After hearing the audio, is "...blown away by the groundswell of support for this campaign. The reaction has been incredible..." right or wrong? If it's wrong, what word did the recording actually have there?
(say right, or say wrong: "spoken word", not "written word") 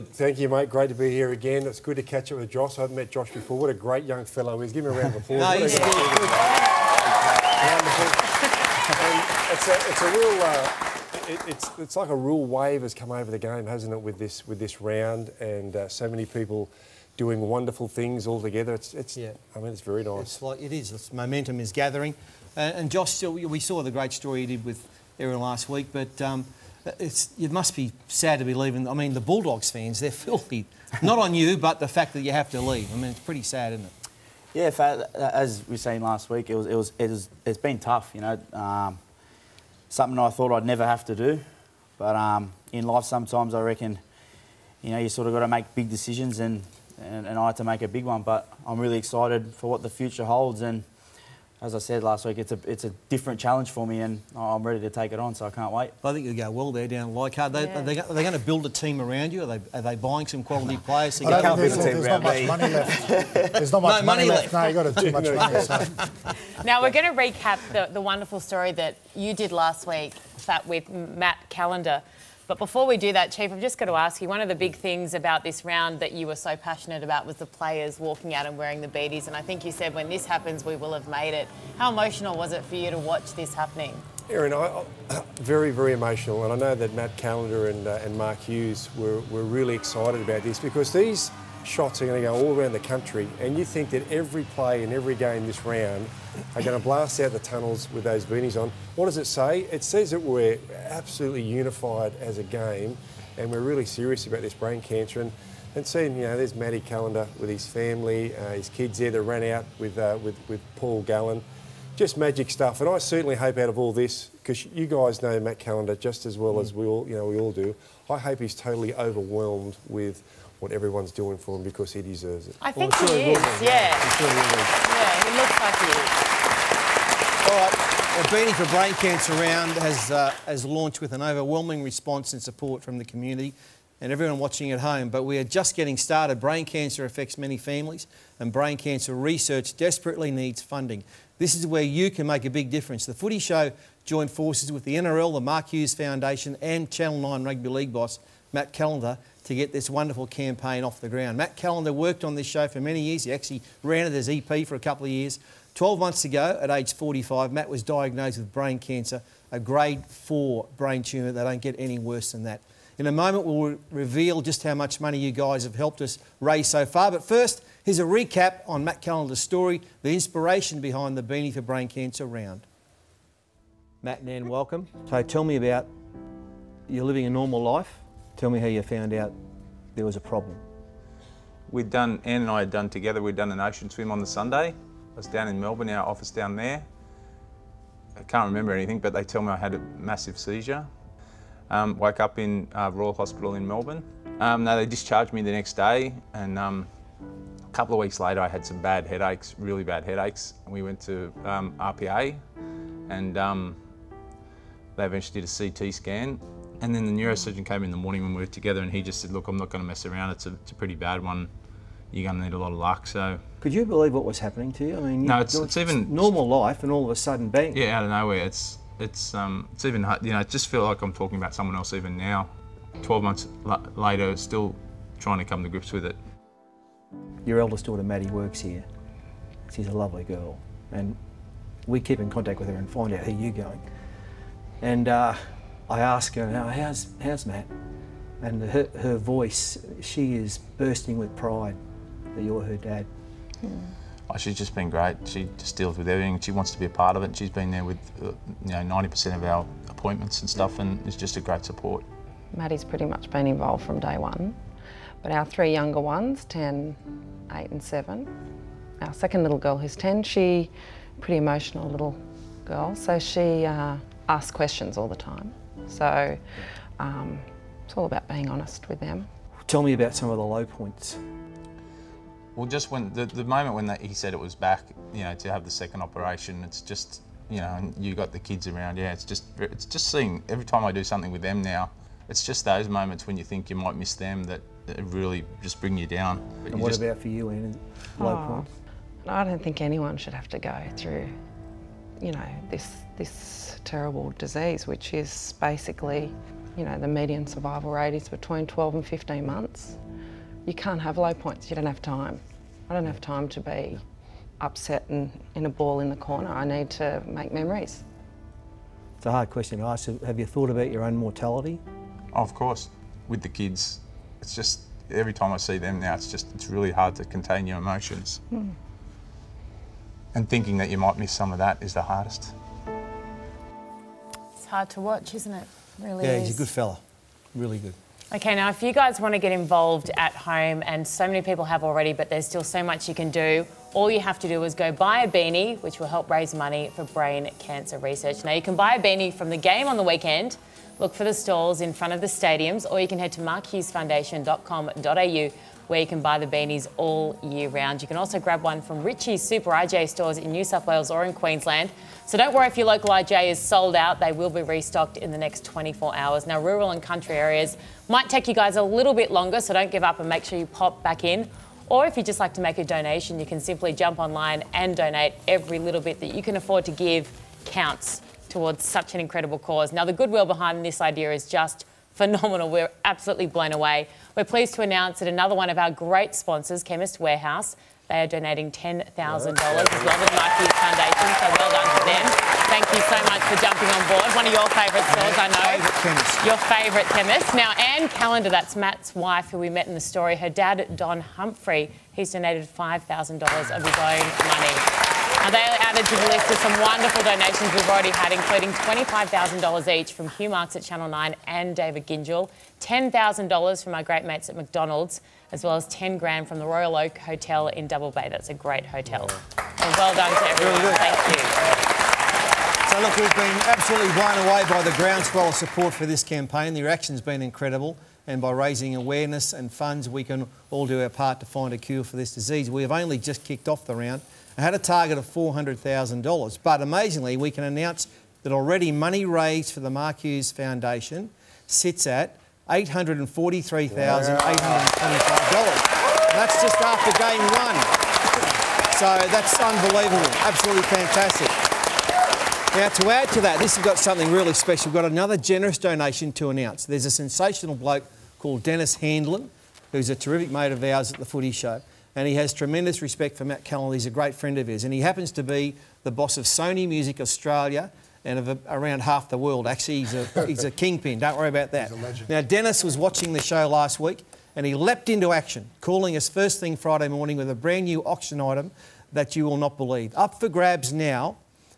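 right.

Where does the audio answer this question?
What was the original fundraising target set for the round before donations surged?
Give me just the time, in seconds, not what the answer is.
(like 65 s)
425 s.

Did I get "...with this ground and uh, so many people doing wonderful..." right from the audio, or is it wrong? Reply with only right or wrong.
wrong.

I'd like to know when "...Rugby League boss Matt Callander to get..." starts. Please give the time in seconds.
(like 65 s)
147 s.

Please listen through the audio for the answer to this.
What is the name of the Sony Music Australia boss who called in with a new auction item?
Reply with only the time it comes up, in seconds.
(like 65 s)
448 s.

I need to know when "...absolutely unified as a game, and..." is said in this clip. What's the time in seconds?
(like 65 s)
100 s.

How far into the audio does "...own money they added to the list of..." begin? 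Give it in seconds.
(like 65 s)
393 s.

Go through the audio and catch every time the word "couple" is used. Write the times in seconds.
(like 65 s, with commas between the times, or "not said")
154 s, 197 s.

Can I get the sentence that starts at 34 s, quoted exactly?
Yeah, as we saying last week, it was, it was, it was it's been tough, you know.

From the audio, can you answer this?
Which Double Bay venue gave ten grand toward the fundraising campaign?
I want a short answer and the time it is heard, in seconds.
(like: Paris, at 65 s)
Royal Oak Hotel, at 406 s.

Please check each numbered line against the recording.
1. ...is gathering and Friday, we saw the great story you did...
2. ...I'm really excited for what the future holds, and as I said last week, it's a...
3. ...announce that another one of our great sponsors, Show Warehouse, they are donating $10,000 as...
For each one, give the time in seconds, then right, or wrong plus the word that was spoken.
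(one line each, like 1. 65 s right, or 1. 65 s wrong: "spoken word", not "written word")
1. 21 s wrong: "Josh", not "Friday"
2. 48 s right
3. 374 s wrong: "Chemist", not "Show".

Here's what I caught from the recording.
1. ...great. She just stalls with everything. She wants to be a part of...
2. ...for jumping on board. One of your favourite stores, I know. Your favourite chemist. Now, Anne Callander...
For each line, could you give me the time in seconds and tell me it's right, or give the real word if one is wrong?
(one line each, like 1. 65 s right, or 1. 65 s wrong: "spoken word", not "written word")
1. 244 s wrong: "deals", not "stalls"
2. 383 s right.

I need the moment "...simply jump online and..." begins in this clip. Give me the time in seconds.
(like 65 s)
363 s.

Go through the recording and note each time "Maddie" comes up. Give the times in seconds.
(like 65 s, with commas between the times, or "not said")
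228 s, 252 s.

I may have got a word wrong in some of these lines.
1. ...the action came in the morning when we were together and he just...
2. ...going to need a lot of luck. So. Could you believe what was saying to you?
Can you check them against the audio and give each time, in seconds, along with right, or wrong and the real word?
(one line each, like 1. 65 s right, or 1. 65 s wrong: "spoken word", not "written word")
1. 207 s wrong: "neurosurgeon", not "action"
2. 212 s wrong: "happening", not "saying".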